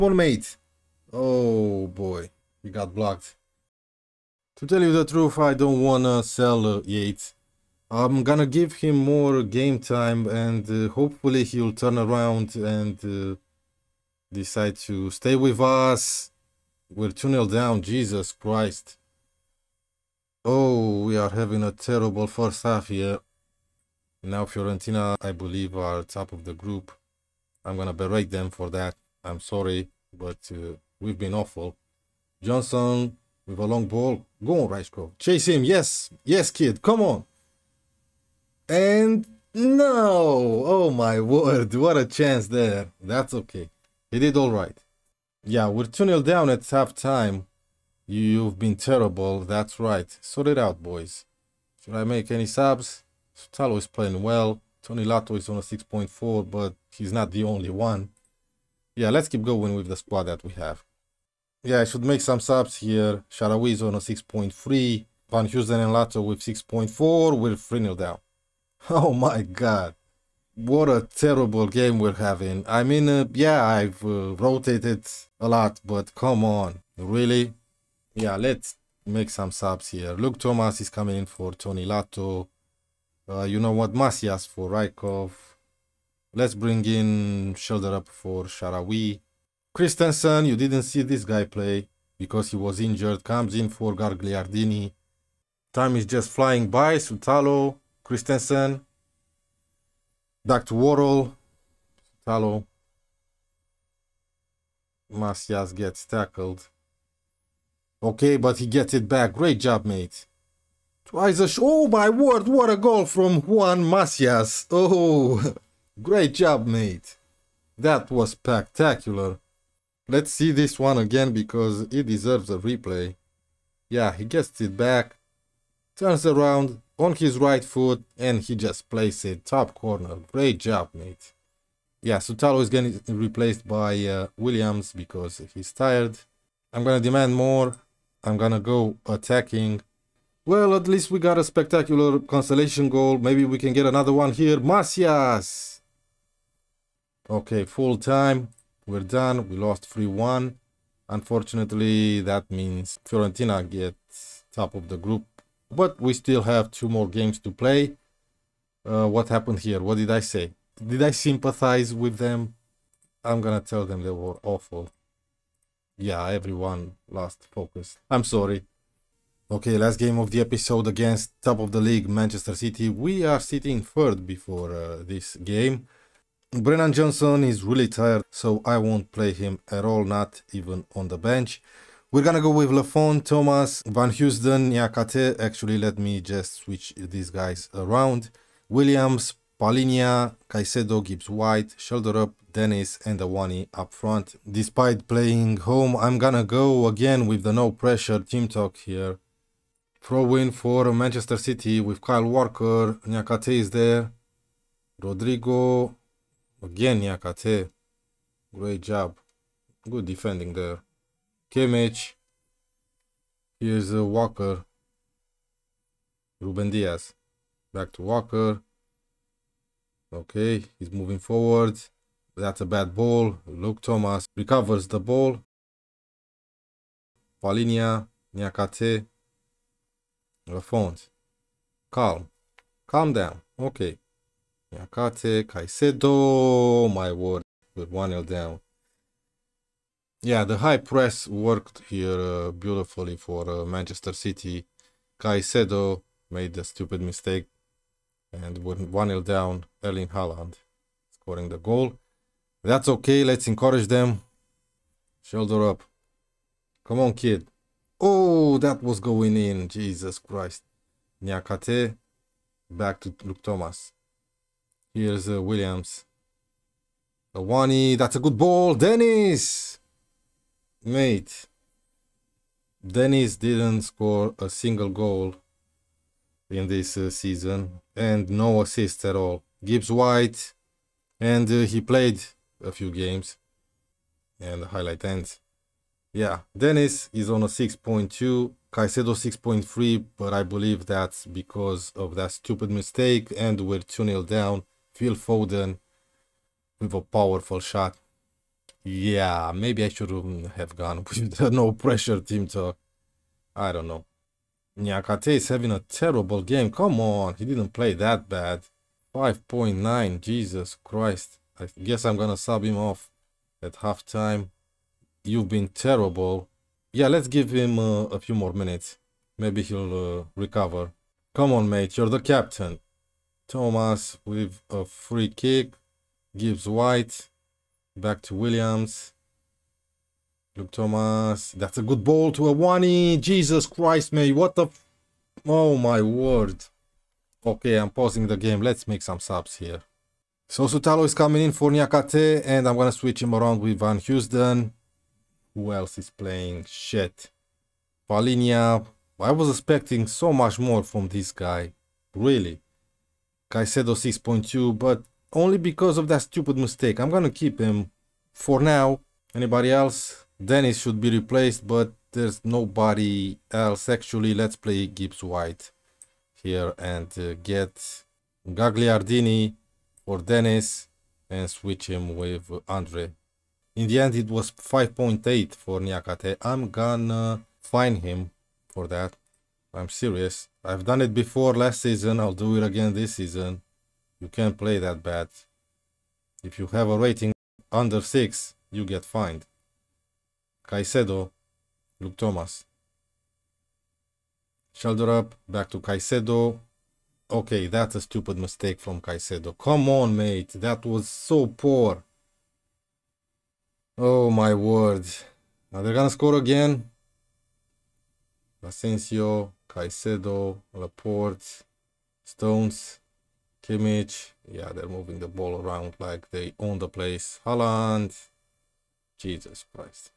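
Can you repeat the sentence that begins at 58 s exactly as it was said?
Yeah, let's keep going with the squad that we have.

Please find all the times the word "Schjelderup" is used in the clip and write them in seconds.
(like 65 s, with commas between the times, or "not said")
87 s, 255 s, 394 s.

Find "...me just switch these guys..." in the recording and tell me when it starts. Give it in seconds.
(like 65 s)
185 s.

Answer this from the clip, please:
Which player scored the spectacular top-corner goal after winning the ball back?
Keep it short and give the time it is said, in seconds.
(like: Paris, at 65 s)
Juan Macias, at 113 s.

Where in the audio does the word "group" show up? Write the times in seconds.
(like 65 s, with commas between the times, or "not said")
26 s, 154 s.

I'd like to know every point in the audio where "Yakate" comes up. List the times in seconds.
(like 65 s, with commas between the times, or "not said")
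184 s, 207 s, 234 s.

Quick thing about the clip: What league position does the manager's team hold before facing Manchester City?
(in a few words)
Third.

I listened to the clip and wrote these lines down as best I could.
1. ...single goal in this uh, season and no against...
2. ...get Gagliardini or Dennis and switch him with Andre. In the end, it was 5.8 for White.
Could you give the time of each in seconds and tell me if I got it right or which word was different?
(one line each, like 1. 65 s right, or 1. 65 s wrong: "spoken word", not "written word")
1. 274 s wrong: "assist", not "against"
2. 367 s wrong: "Niakhaté", not "White".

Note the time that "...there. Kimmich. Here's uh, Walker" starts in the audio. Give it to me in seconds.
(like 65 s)
210 s.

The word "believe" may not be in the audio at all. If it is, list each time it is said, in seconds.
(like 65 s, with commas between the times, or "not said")
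25 s, 290 s.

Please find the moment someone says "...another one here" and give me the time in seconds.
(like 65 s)
143 s.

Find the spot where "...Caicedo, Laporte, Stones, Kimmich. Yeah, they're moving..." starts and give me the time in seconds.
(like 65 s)
409 s.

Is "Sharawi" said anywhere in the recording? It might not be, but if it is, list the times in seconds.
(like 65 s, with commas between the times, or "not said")
88 s.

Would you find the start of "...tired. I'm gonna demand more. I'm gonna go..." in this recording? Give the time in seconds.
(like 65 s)
135 s.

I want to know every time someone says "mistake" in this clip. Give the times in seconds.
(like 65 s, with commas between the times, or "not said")
247 s, 292 s, 356 s, 398 s.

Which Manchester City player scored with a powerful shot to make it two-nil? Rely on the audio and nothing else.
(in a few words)
Phil Foden.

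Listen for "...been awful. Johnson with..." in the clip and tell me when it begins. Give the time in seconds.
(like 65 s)
31 s.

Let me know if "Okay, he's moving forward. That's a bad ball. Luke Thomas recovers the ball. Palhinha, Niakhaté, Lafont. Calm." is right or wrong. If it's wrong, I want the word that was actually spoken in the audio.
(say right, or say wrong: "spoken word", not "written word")
right.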